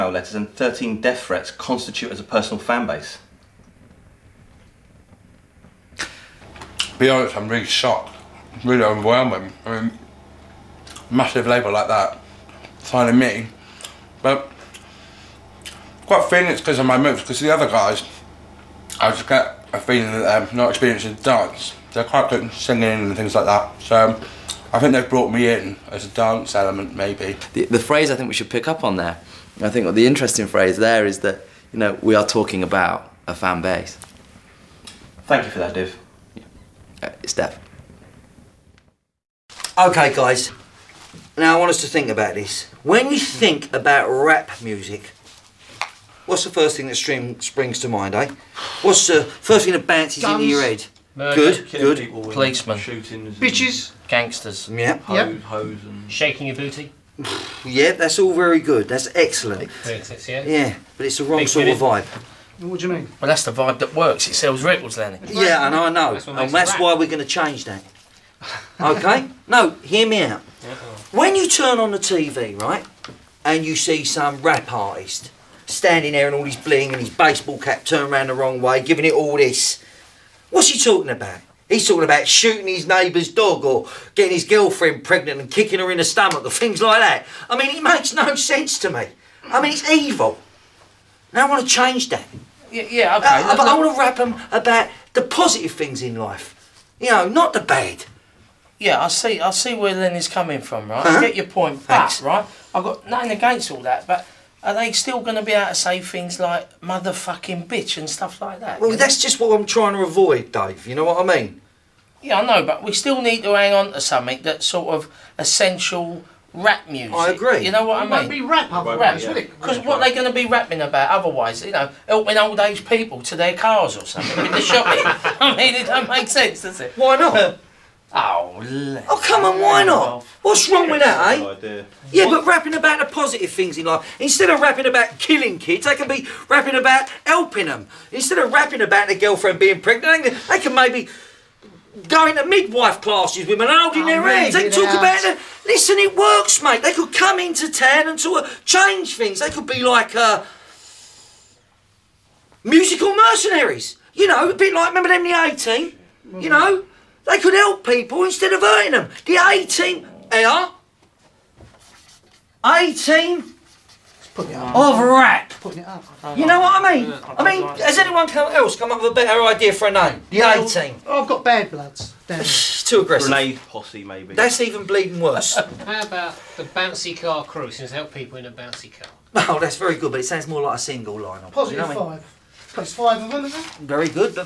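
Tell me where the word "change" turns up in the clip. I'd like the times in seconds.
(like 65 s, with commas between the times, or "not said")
67 s, 91 s, 148 s.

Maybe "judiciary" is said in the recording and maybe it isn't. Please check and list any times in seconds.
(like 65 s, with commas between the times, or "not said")
not said.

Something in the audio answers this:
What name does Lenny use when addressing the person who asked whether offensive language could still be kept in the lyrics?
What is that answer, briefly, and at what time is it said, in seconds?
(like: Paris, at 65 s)
Dave, at 110 s.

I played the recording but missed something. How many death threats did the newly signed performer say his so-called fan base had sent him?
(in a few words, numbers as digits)
13.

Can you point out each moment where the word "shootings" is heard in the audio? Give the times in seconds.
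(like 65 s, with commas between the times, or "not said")
52 s, 82 s.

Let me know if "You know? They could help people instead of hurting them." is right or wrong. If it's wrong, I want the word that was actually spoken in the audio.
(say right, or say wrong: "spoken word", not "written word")
right.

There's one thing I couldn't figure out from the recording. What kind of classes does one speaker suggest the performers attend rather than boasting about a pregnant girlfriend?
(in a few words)
midwife classes.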